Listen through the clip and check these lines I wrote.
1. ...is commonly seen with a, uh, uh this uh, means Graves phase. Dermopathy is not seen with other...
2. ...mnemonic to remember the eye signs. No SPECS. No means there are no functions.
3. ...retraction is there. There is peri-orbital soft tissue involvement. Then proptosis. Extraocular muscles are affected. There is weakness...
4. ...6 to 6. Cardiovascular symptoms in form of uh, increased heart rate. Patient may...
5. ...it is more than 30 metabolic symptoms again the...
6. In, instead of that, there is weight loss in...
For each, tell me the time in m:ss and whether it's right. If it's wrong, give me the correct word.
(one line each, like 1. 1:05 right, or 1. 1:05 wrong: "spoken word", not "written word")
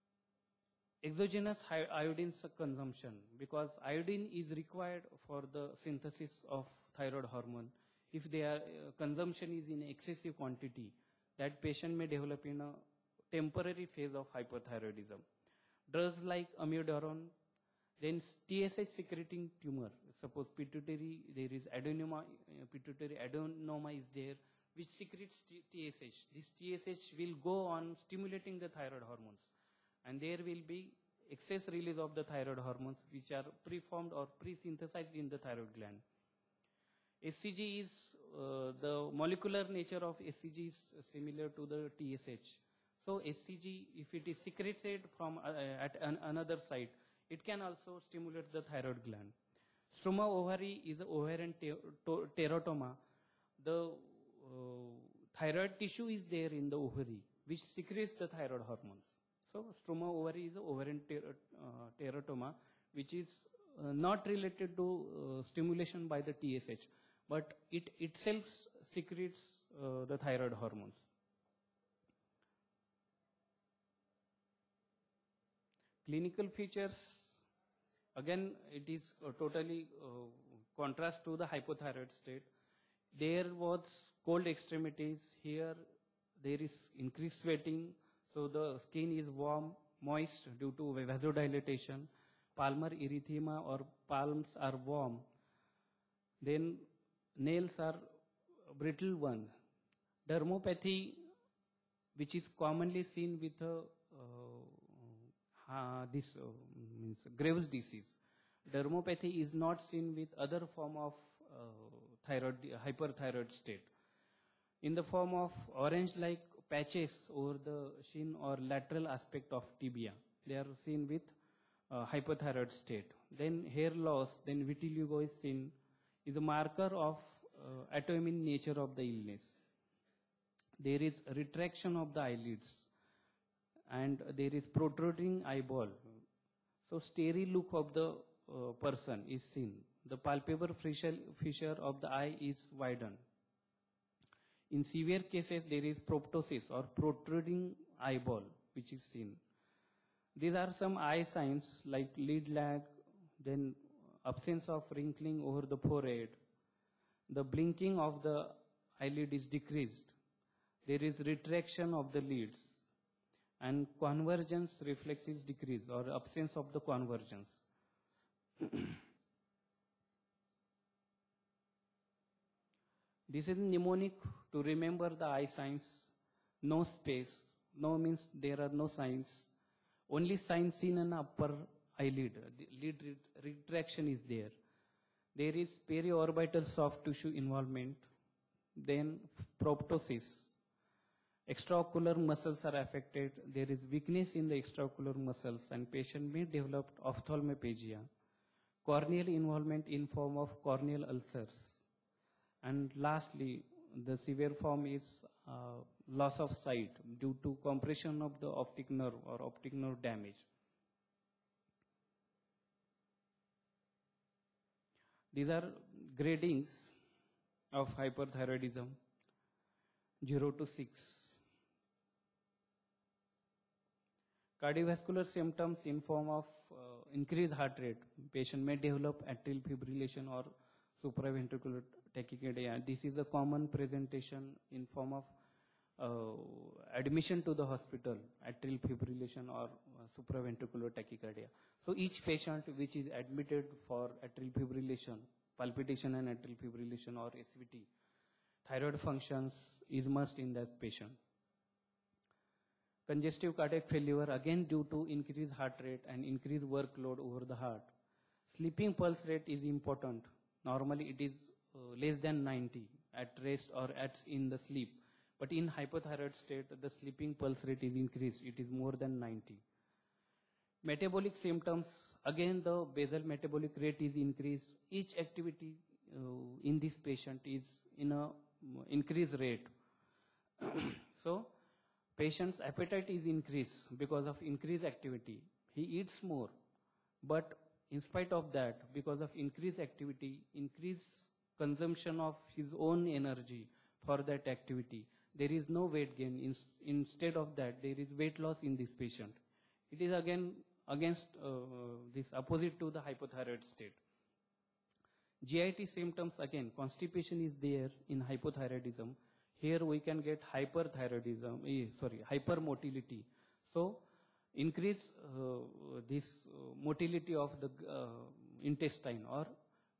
1. 1:42 wrong: "disease", not "phase"
2. 2:53 wrong: "signs", not "functions"
3. 3:03 right
4. 3:40 wrong: "0", not "6"
5. 4:28 wrong: "90", not "30"
6. 4:56 right.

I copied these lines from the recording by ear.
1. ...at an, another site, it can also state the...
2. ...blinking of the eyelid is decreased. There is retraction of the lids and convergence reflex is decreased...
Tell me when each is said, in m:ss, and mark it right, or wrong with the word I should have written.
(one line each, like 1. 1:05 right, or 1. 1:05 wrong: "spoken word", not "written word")
1. 0:45 wrong: "stimulate", not "state"
2. 2:37 right.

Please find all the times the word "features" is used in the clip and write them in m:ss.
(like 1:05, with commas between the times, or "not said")
1:16.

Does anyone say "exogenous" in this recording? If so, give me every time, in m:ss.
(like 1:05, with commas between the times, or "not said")
0:01.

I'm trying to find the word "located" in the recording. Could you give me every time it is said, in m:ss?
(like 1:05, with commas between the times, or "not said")
not said.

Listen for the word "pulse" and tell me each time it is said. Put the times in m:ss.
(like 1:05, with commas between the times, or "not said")
4:18, 4:27.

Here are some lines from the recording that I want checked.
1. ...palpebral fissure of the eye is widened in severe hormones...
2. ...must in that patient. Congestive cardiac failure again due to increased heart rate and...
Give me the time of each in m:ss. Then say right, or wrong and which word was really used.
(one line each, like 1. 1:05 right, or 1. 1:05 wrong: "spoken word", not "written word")
1. 2:20 wrong: "cases", not "hormones"
2. 4:10 right.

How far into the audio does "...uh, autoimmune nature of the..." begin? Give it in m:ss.
2:07.